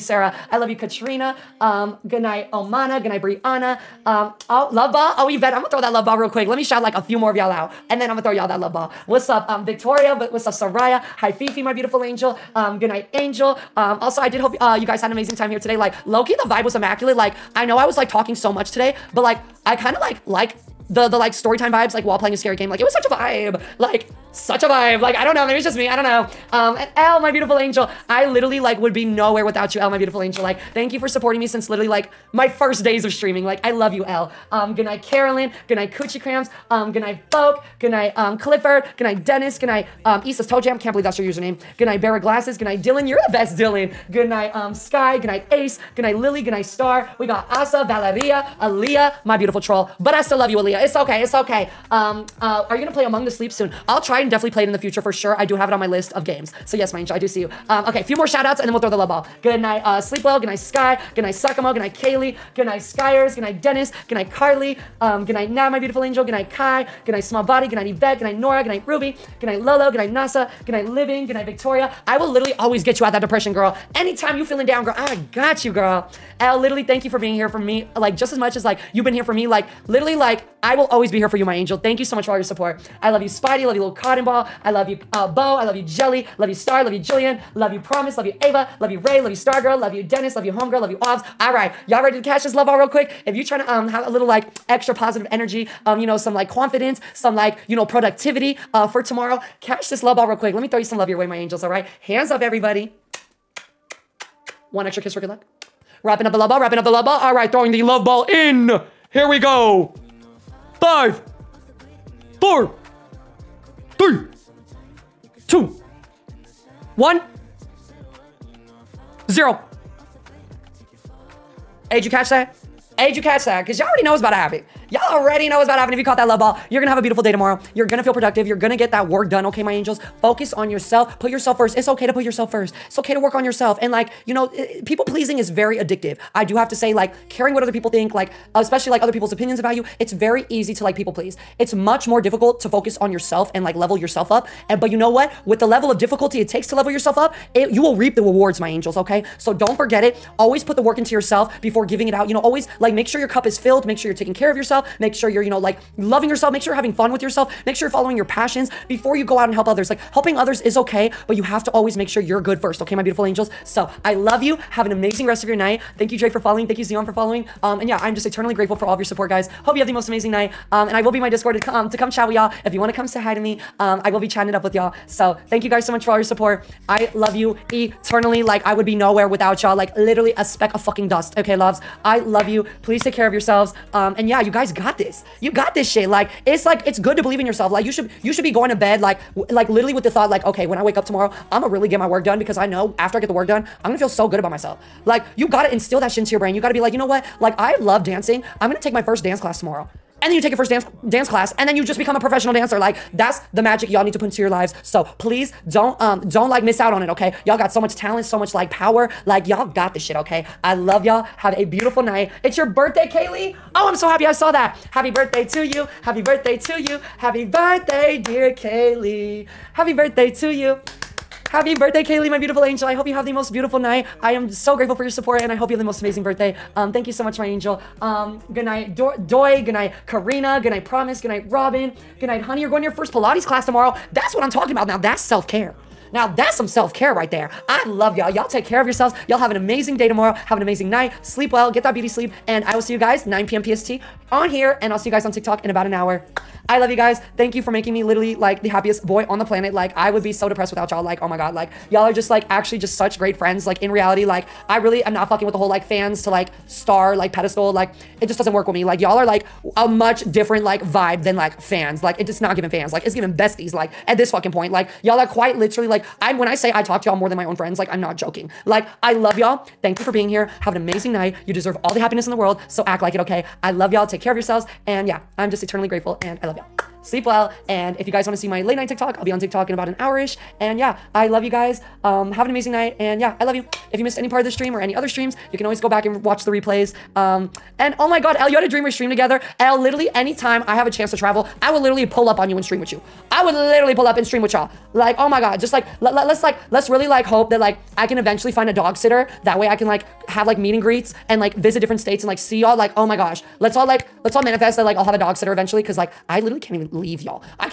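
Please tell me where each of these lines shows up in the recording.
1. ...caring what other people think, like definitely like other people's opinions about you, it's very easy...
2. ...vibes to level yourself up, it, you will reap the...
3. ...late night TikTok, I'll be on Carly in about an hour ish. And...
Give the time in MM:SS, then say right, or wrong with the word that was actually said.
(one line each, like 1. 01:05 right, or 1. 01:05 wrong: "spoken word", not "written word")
1. 02:17 wrong: "especially", not "definitely"
2. 02:26 wrong: "takes", not "vibes"
3. 04:38 wrong: "TikTok", not "Carly".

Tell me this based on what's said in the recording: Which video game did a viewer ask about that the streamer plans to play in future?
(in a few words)
Among the Sleep.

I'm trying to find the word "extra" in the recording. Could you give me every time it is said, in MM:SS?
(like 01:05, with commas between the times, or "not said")
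01:34, 01:44.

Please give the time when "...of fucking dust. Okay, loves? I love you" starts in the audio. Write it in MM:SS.
03:00.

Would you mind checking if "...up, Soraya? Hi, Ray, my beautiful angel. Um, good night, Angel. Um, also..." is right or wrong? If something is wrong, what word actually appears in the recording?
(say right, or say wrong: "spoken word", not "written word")
wrong: "Fifi", not "Ray".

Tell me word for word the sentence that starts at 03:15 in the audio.
Like, you gotta instill that shit into your brain.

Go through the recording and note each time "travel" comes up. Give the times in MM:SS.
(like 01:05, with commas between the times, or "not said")
04:51.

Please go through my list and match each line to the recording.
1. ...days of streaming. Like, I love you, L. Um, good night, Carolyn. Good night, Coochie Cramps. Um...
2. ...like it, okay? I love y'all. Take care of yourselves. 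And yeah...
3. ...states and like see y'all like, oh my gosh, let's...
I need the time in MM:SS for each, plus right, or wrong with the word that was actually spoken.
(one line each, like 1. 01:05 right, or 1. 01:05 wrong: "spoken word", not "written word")
1. 00:32 right
2. 04:33 right
3. 05:01 right.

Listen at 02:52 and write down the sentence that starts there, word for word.
If you want to come say hi to me, um, I will be chatting it up with y'all.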